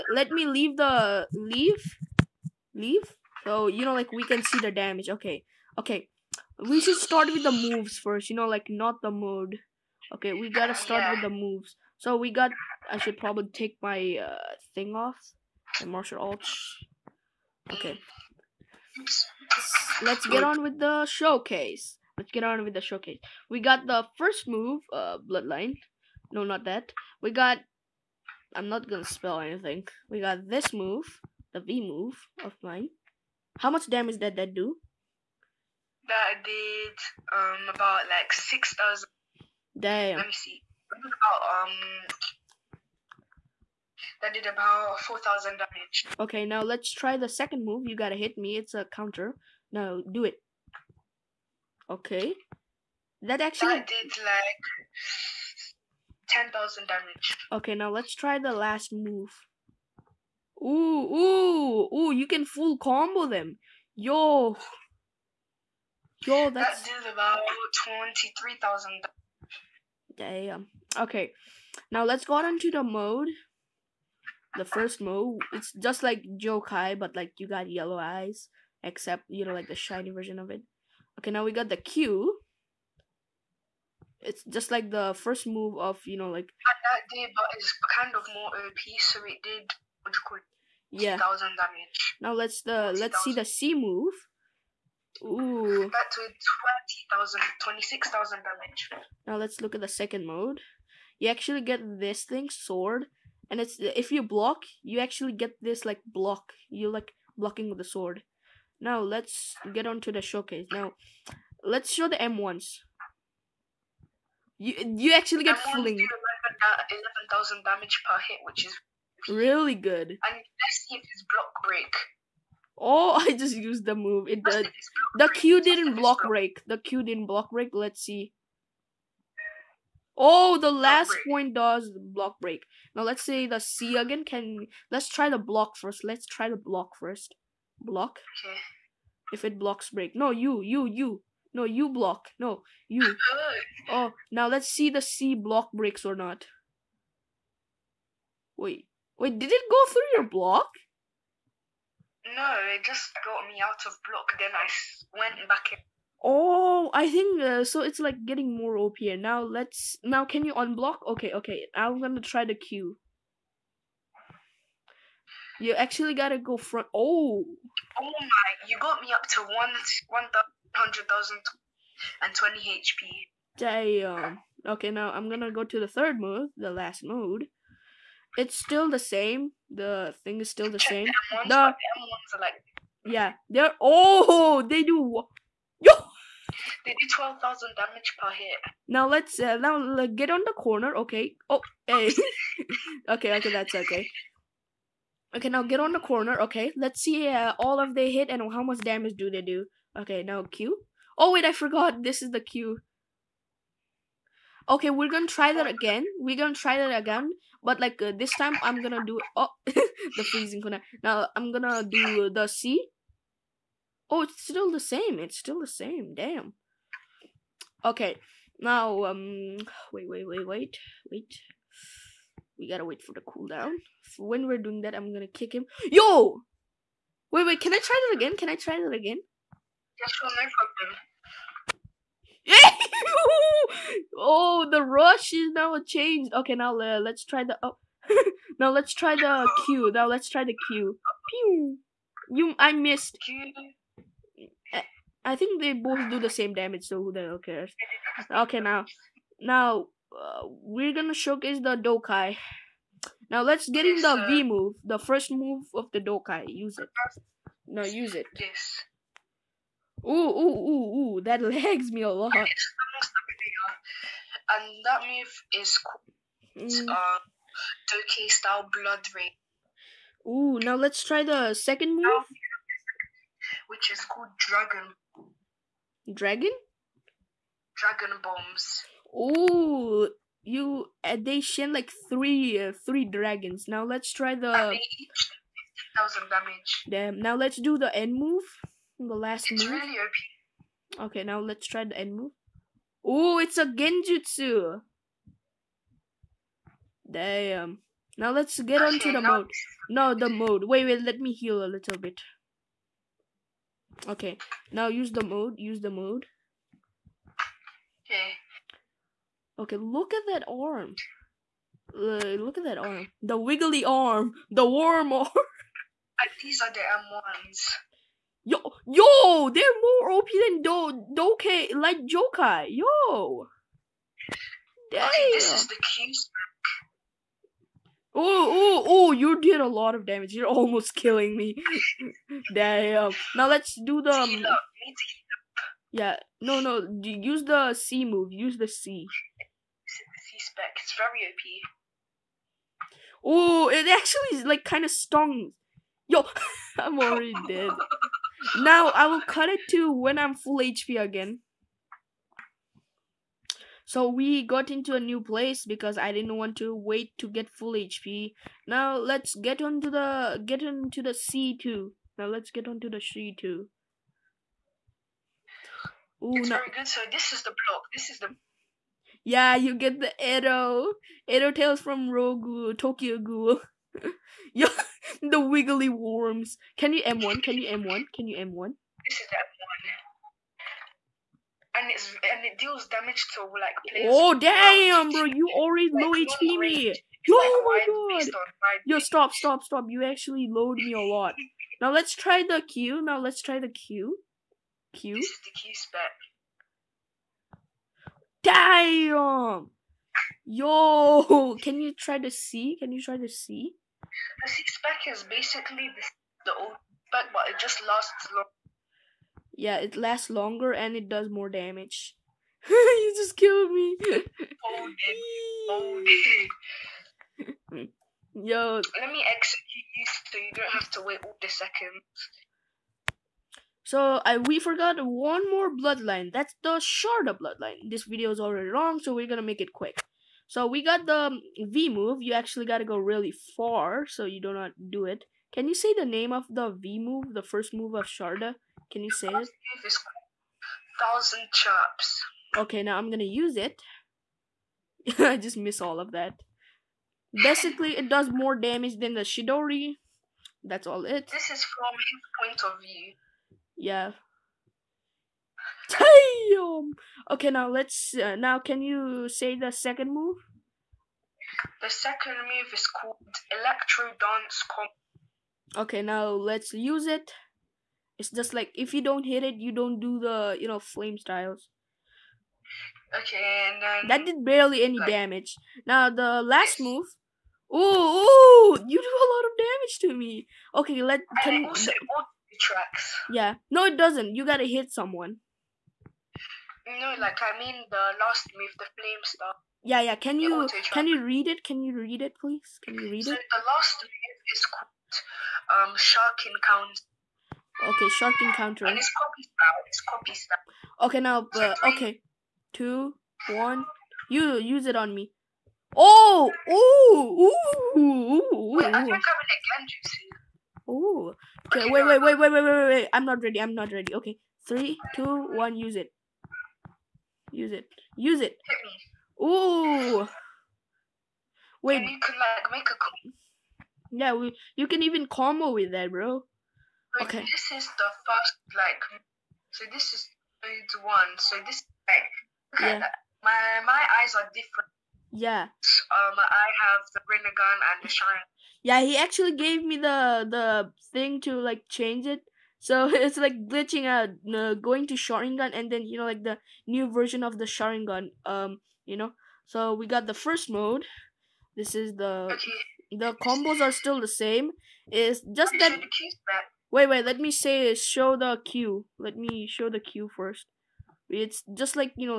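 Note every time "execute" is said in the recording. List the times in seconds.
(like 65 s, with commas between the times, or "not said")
419 s.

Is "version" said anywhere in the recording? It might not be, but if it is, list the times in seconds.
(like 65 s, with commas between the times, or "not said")
80 s, 547 s.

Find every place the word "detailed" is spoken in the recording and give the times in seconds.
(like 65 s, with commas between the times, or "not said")
not said.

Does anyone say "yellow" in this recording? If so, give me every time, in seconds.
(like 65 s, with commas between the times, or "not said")
77 s.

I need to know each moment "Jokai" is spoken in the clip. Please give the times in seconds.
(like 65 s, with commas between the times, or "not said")
76 s, 322 s.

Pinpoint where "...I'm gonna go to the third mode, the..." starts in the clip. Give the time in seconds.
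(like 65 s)
175 s.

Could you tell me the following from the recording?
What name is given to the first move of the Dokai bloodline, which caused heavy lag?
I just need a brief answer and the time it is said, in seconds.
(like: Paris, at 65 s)
Blood Rain, at 268 s.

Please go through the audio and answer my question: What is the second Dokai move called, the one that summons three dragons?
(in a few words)
Dragon bombs.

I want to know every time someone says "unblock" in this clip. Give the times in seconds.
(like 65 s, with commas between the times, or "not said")
160 s.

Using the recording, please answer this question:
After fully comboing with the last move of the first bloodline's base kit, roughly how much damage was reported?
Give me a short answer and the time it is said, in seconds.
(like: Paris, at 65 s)
23,000, at 67 s.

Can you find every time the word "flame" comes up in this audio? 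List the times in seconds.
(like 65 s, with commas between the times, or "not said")
470 s, 488 s.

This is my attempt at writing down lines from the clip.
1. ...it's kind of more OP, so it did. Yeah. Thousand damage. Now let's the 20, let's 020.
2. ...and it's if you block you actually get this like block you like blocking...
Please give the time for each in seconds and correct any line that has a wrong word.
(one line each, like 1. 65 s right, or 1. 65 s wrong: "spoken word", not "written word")
1. 87 s wrong: "000", not "020"
2. 103 s right.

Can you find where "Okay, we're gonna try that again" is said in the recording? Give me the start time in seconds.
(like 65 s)
204 s.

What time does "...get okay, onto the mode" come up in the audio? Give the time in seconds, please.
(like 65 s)
298 s.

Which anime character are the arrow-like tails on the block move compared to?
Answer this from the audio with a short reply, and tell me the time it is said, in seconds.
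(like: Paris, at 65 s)
Tokyo Ghoul, at 372 s.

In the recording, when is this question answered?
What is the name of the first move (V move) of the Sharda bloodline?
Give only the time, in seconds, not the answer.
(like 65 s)
440 s.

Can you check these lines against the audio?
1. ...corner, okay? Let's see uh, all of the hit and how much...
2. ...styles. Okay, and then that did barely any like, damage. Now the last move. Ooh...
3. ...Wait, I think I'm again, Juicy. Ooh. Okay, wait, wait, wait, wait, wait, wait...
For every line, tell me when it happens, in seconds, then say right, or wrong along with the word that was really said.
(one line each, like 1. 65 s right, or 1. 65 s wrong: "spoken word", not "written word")
1. 195 s right
2. 471 s right
3. 508 s right.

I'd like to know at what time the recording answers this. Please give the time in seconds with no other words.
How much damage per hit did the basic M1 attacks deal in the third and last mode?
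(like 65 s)
187 s.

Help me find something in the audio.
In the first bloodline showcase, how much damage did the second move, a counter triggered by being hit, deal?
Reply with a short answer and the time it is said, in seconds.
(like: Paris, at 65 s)
10,000, at 56 s.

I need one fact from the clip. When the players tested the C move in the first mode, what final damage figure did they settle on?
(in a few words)
26,000.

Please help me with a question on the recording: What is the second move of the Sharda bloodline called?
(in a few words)
Electro Dance Combo.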